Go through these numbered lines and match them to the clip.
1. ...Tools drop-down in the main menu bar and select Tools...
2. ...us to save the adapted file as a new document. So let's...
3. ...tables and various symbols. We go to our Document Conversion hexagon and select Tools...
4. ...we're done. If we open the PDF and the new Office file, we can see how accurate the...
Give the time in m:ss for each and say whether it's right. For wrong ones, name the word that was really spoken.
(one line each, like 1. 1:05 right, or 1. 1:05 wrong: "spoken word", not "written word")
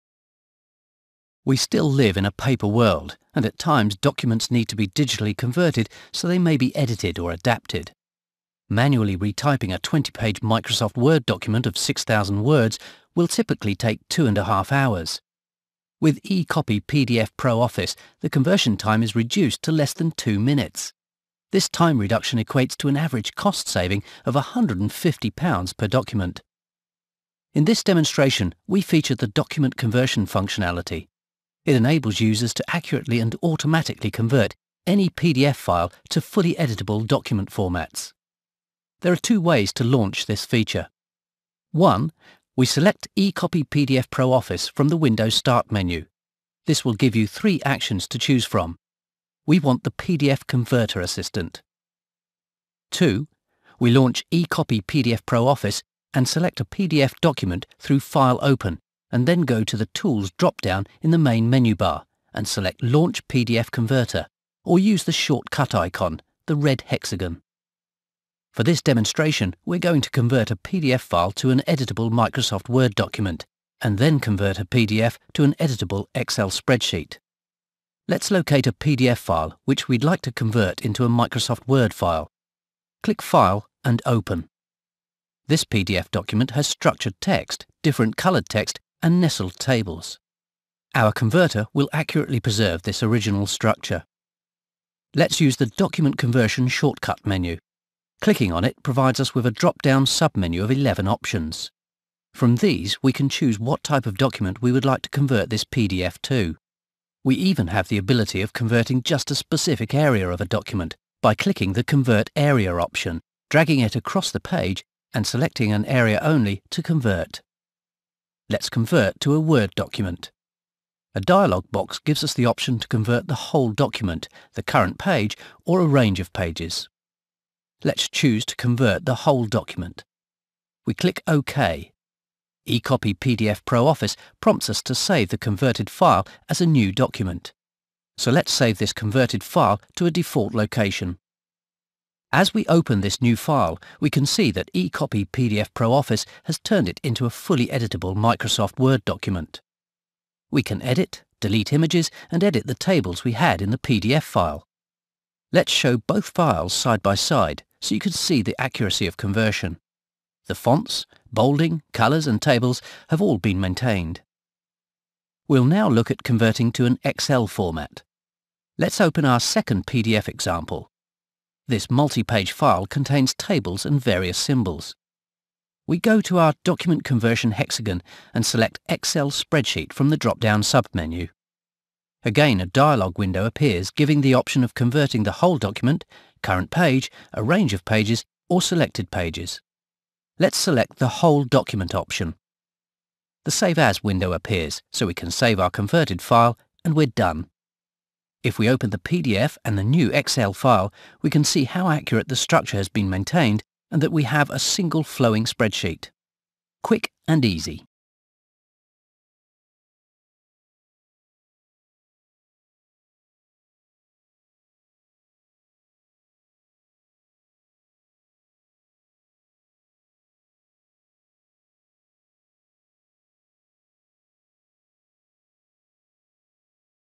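1. 0:59 wrong: "Launch", not "Tools"
2. 2:14 wrong: "converted", not "adapted"
3. 2:53 wrong: "Excel", not "Tools"
4. 3:16 wrong: "Excel", not "Office".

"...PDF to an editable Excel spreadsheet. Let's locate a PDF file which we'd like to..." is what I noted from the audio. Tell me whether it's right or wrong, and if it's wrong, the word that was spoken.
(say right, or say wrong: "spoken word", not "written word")
right.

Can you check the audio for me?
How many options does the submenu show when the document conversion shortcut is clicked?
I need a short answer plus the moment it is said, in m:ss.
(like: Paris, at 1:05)
11, at 1:40.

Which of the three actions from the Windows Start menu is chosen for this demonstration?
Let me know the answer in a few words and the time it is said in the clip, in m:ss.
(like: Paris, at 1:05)
PDF Converter Assistant, at 0:49.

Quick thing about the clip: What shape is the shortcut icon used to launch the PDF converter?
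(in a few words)
Red hexagon.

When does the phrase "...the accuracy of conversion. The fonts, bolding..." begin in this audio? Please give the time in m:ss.
2:38.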